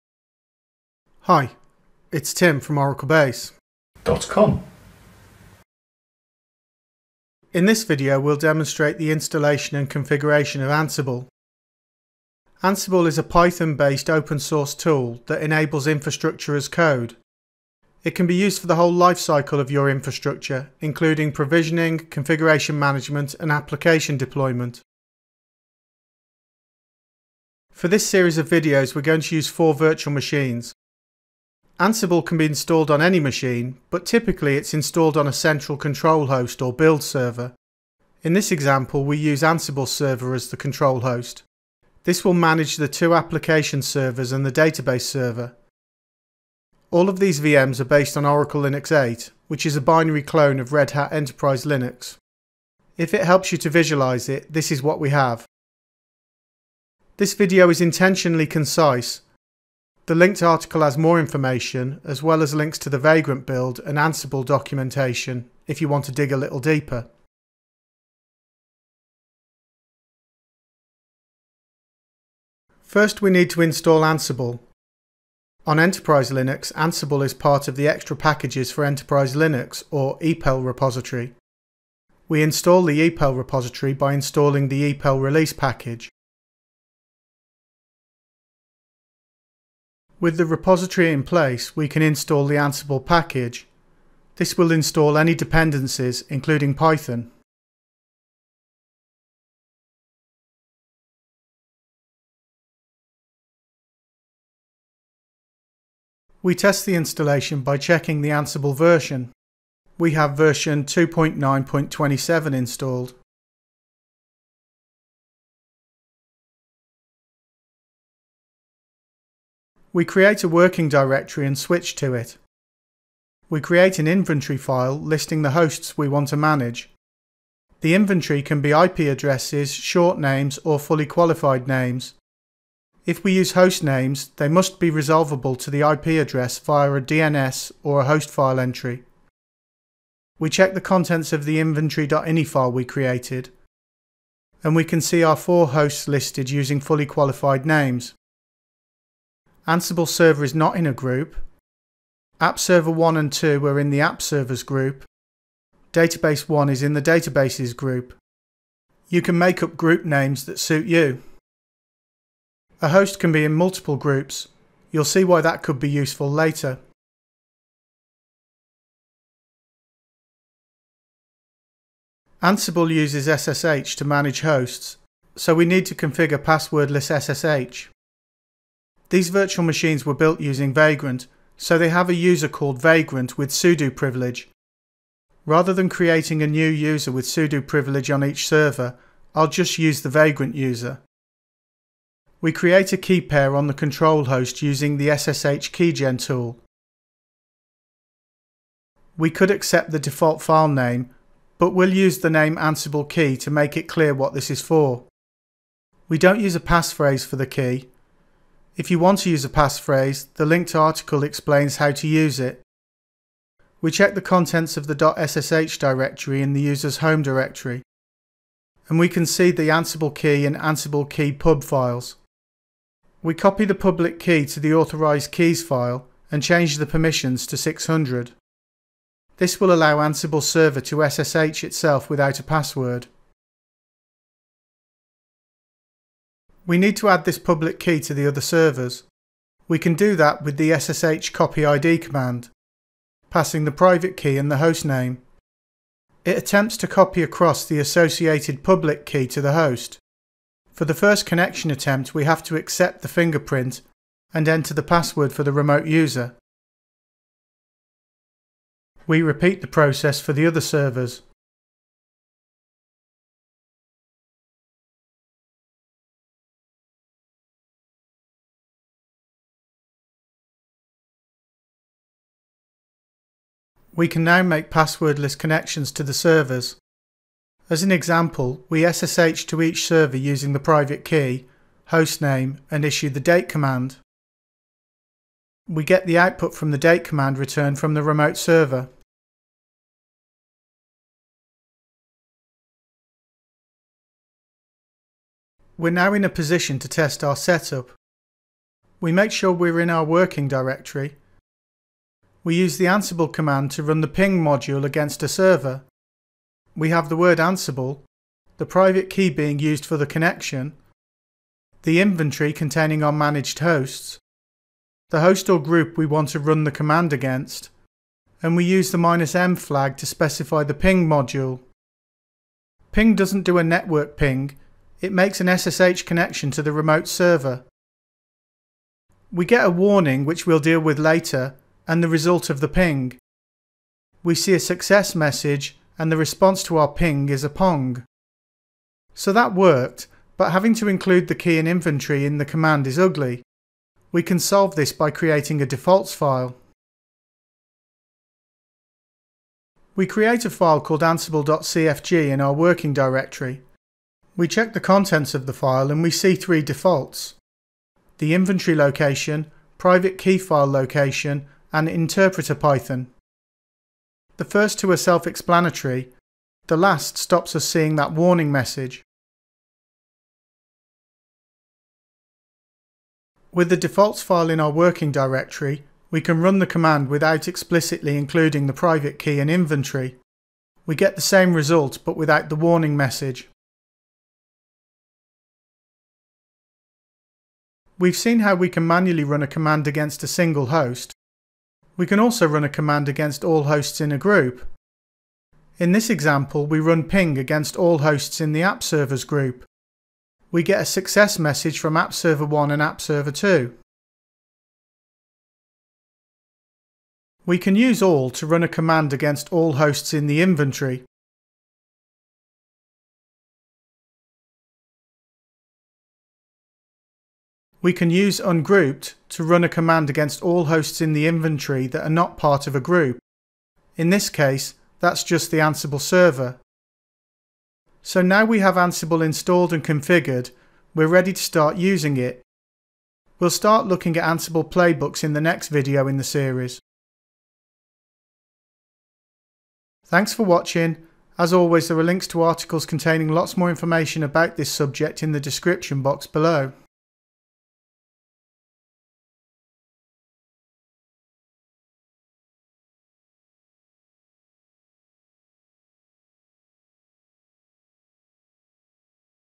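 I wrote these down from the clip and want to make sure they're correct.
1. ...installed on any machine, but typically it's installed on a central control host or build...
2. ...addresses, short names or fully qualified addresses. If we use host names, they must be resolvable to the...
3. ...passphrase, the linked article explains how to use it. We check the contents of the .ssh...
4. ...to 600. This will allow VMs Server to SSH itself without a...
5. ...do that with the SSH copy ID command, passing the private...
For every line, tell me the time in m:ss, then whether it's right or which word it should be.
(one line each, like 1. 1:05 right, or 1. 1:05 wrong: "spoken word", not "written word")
1. 0:32 right
2. 2:08 wrong: "names", not "addresses"
3. 3:29 right
4. 3:47 wrong: "Ansible", not "VMs"
5. 3:59 right.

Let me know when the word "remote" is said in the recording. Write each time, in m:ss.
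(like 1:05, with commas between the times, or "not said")
4:15, 4:48, 5:26.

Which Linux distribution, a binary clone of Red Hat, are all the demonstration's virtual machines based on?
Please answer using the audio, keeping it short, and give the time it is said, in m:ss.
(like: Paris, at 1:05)
Oracle Linux 8, at 0:48.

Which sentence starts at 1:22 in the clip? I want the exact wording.
We install the EPEL repository by installing the EPEL release package.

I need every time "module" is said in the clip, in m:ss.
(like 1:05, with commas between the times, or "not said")
5:04, 5:21.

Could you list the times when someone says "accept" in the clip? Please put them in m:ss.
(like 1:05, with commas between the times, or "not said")
3:19, 4:12.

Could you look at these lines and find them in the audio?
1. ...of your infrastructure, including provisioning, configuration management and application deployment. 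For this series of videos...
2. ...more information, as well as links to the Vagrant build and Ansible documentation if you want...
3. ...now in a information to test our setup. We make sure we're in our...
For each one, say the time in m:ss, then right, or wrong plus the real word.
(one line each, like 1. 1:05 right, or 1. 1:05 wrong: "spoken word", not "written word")
1. 0:19 right
2. 1:00 right
3. 4:55 wrong: "position", not "information".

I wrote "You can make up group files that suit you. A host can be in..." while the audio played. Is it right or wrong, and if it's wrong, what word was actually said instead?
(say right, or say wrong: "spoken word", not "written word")
wrong: "names", not "files".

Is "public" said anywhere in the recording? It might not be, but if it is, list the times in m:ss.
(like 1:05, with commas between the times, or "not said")
3:43, 3:57, 4:08.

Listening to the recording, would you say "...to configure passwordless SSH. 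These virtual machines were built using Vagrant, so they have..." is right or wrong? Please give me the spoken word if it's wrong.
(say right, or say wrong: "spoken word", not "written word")
right.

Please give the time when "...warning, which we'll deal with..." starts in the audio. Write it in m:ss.
5:29.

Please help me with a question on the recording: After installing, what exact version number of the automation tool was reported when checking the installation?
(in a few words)
2.9.27.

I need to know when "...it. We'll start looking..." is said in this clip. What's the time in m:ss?
7:12.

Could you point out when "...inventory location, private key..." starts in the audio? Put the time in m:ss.
5:58.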